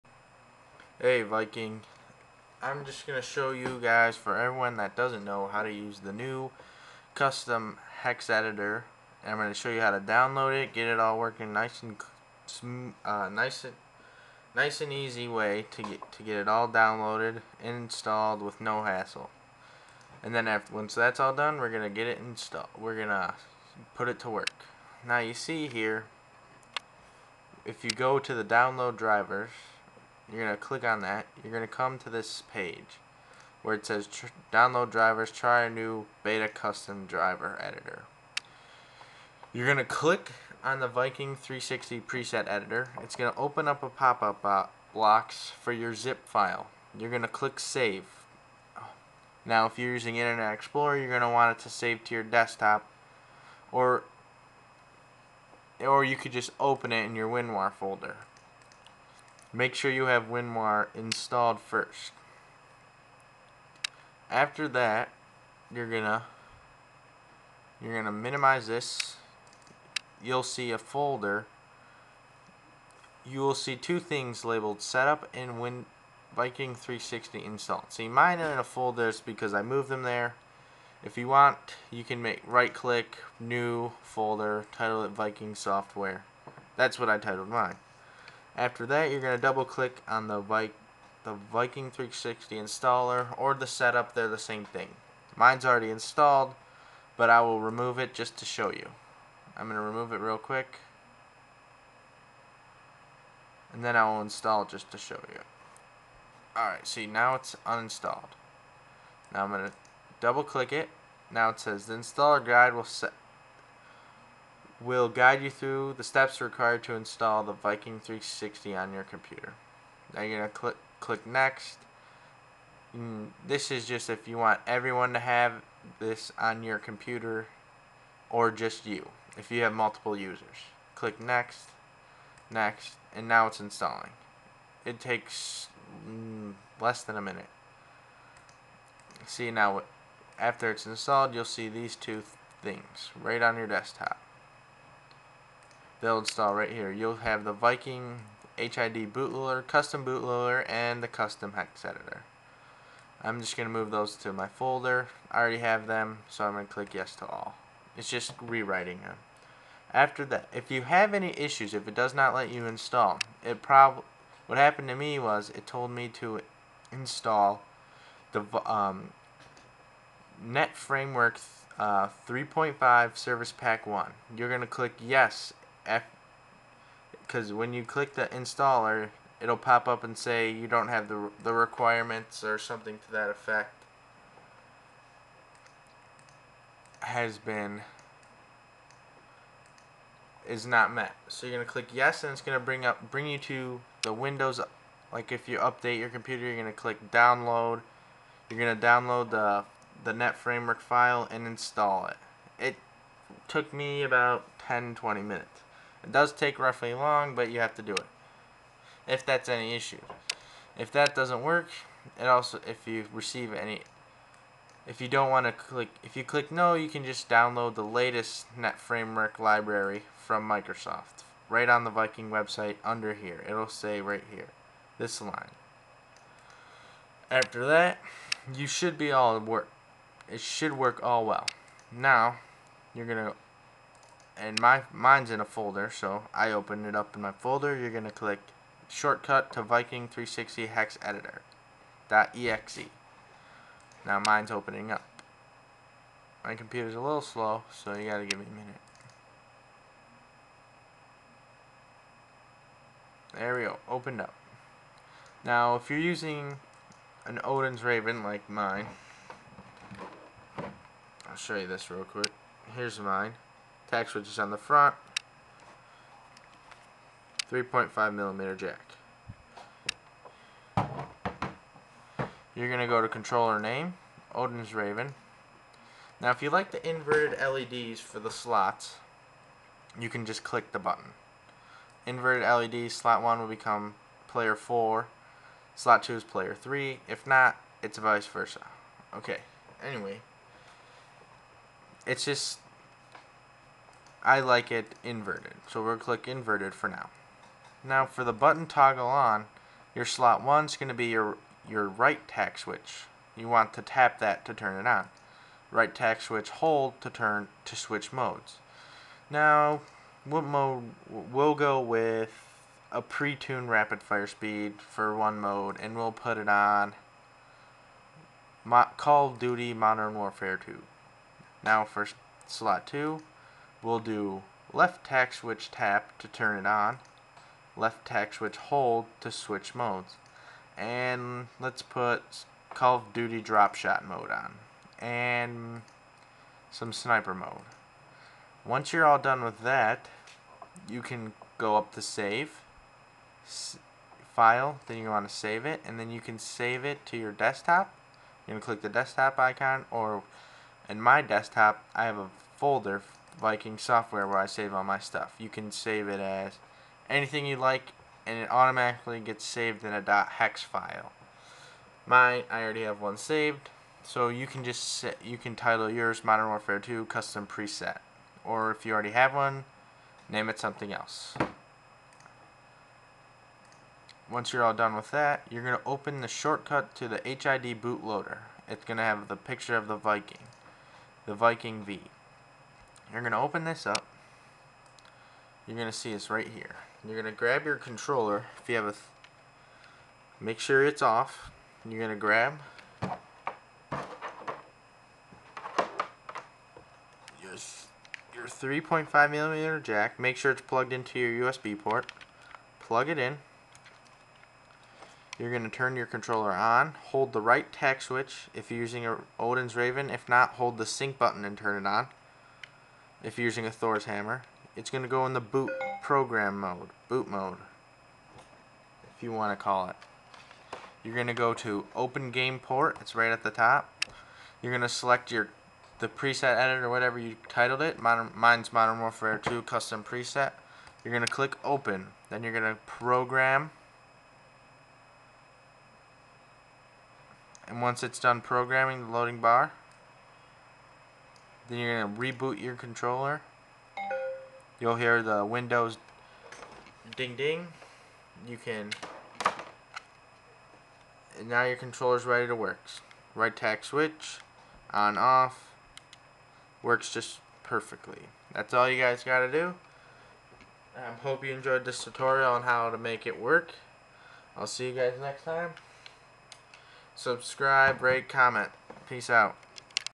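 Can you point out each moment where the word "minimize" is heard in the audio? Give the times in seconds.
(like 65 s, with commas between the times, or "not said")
68 s.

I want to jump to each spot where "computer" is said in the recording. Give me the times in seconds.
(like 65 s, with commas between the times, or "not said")
119 s, 126 s, 196 s, 246 s.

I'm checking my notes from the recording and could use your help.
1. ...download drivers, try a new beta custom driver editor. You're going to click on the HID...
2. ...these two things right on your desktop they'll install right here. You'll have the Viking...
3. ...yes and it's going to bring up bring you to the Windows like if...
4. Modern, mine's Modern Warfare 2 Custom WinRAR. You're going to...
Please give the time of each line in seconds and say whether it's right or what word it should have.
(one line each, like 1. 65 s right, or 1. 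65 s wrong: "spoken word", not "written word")
1. 34 s wrong: "Viking", not "HID"
2. 141 s right
3. 191 s right
4. 428 s wrong: "Preset", not "WinRAR".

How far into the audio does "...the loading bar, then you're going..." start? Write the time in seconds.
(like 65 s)
439 s.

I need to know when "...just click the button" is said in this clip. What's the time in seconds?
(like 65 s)
280 s.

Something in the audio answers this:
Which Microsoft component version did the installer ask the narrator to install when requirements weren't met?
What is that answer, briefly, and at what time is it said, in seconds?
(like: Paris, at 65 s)
.NET Framework 3.5 Service Pack 1, at 170 s.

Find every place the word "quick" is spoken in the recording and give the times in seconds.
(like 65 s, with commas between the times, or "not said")
100 s, 262 s.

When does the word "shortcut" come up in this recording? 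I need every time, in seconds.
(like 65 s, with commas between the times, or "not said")
238 s, 376 s.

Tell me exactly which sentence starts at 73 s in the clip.
You will see two things labeled setup and win Viking 360 install.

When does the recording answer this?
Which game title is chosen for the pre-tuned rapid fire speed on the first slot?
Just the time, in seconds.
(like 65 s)
318 s.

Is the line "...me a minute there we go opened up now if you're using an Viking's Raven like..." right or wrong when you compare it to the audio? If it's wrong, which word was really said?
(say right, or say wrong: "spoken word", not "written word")
wrong: "Odin", not "Viking".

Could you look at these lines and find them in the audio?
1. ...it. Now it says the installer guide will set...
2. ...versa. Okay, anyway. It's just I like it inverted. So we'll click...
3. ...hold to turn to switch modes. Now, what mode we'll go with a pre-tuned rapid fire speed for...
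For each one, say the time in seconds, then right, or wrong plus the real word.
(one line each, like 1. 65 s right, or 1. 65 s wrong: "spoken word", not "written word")
1. 110 s right
2. 288 s right
3. 306 s right.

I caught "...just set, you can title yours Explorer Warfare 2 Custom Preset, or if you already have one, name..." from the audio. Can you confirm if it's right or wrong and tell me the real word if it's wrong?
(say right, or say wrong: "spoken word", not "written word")
wrong: "Modern", not "Explorer".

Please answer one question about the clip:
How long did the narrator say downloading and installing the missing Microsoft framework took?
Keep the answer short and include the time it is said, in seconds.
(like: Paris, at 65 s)
10 to 20 minutes, at 204 s.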